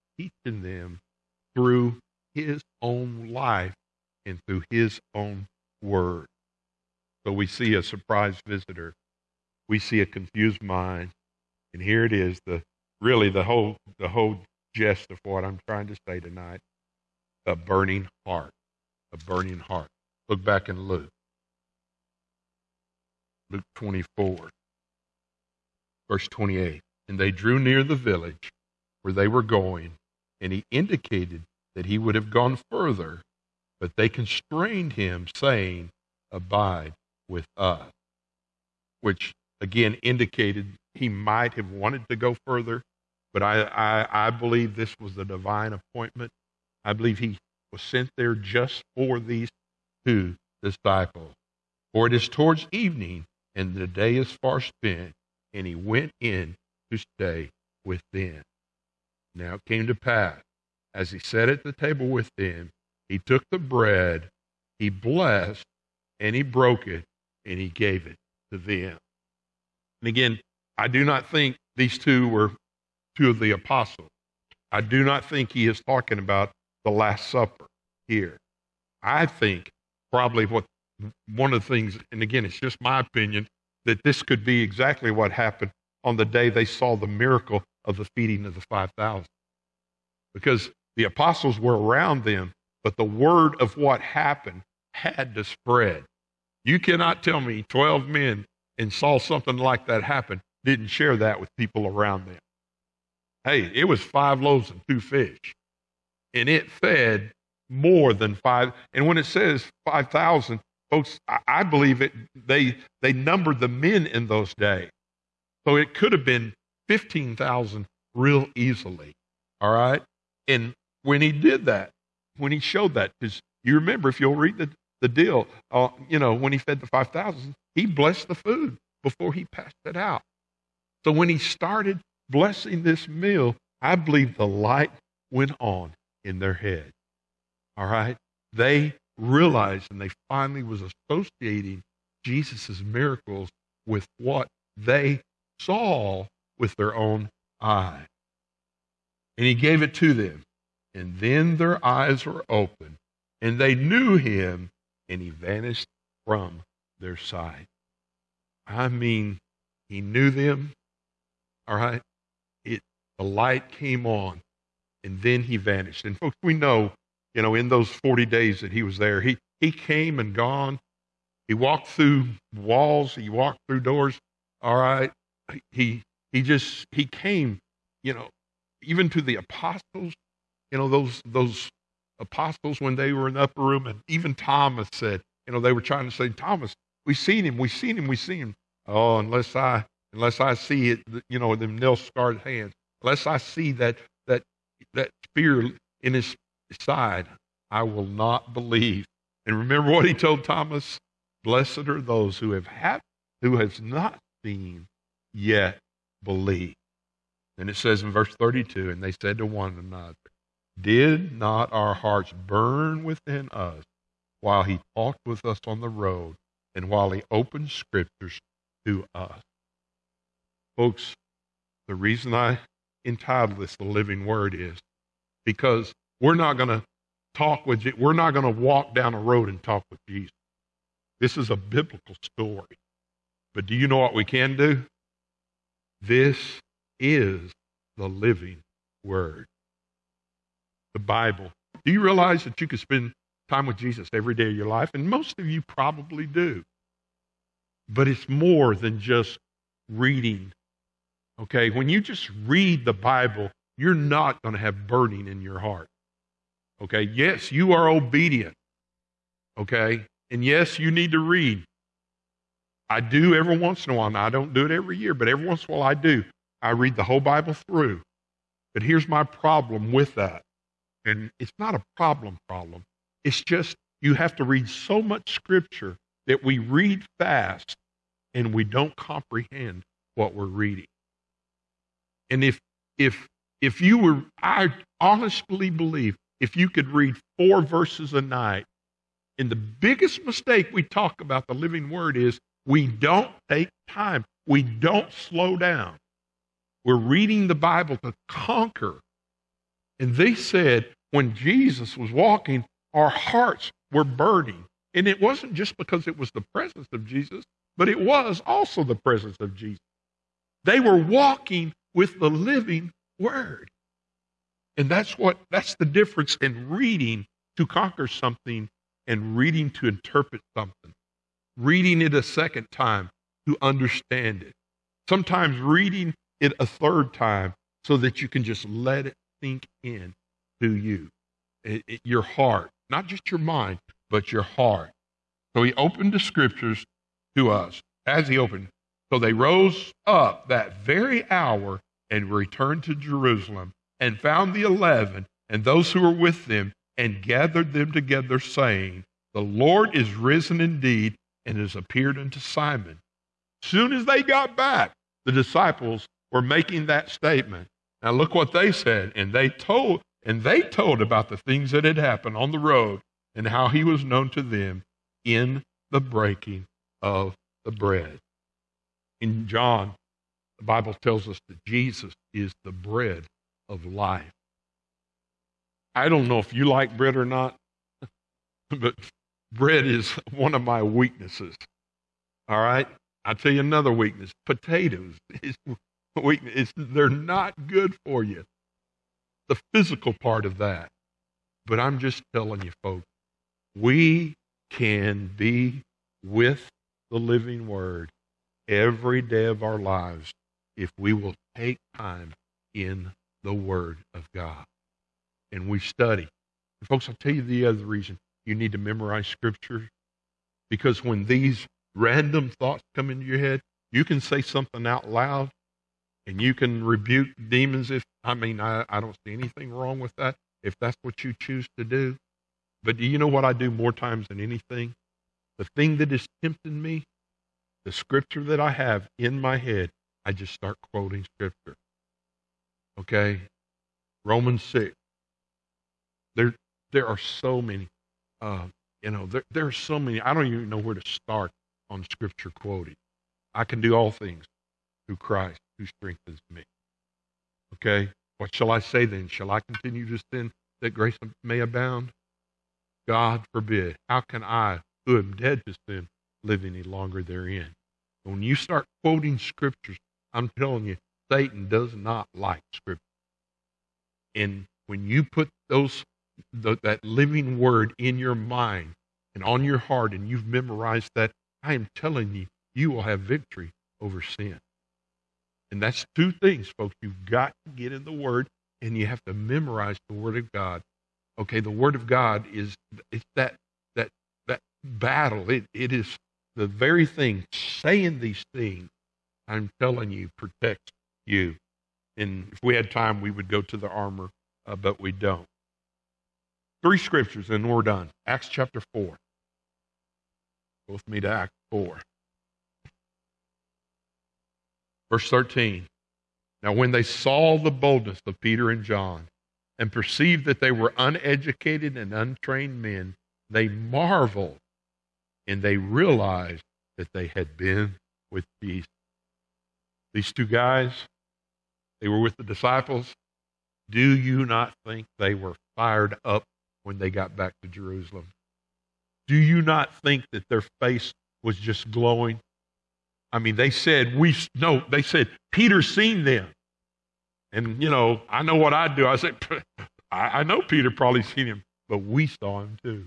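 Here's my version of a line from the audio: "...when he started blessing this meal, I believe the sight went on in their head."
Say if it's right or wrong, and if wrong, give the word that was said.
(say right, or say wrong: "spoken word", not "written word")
wrong: "light", not "sight".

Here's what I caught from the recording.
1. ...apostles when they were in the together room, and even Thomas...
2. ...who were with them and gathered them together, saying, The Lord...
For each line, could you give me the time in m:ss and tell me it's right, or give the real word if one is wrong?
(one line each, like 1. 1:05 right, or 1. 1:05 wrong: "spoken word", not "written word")
1. 3:02 wrong: "upper", not "together"
2. 5:45 right.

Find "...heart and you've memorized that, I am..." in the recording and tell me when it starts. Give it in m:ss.
7:49.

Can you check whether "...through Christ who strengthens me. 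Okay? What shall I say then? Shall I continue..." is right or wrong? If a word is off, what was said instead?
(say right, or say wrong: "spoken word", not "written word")
right.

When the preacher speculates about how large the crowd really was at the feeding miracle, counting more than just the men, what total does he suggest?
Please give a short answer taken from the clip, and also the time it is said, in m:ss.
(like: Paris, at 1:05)
15,000, at 1:56.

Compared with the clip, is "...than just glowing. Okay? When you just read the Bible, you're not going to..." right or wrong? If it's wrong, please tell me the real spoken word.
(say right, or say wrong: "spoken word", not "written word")
wrong: "reading", not "glowing".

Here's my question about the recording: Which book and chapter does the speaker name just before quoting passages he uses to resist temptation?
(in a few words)
Romans 6.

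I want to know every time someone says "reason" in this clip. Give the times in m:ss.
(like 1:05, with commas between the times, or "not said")
3:41, 6:47.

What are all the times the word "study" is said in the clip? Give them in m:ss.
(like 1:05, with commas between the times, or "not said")
6:45.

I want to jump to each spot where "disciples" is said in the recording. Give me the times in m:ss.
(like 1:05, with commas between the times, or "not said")
0:50, 5:55, 8:42.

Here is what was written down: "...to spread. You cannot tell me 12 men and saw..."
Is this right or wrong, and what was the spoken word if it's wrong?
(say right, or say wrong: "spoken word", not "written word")
right.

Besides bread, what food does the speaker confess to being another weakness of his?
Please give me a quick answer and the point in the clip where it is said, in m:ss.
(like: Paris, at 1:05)
potatoes, at 6:24.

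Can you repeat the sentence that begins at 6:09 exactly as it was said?
In John, the Bible tells us that Jesus is the bread of life.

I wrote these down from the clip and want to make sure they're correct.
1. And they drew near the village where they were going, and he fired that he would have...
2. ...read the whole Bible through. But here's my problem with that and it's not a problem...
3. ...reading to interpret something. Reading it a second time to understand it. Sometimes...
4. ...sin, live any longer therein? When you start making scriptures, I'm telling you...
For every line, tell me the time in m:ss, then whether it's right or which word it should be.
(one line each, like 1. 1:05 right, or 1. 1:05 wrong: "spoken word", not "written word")
1. 0:27 wrong: "indicated", not "fired"
2. 4:26 right
3. 5:19 right
4. 7:35 wrong: "quoting", not "making".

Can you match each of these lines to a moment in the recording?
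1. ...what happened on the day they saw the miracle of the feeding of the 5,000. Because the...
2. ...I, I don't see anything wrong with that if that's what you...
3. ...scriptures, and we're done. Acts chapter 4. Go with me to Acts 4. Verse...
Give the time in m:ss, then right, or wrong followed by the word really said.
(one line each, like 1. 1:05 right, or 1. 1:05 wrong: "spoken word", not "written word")
1. 1:25 right
2. 6:58 right
3. 8:16 right.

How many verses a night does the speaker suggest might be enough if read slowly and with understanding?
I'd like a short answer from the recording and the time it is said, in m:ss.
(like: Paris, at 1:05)
4, at 4:47.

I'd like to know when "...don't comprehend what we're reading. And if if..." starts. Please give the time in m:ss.
4:38.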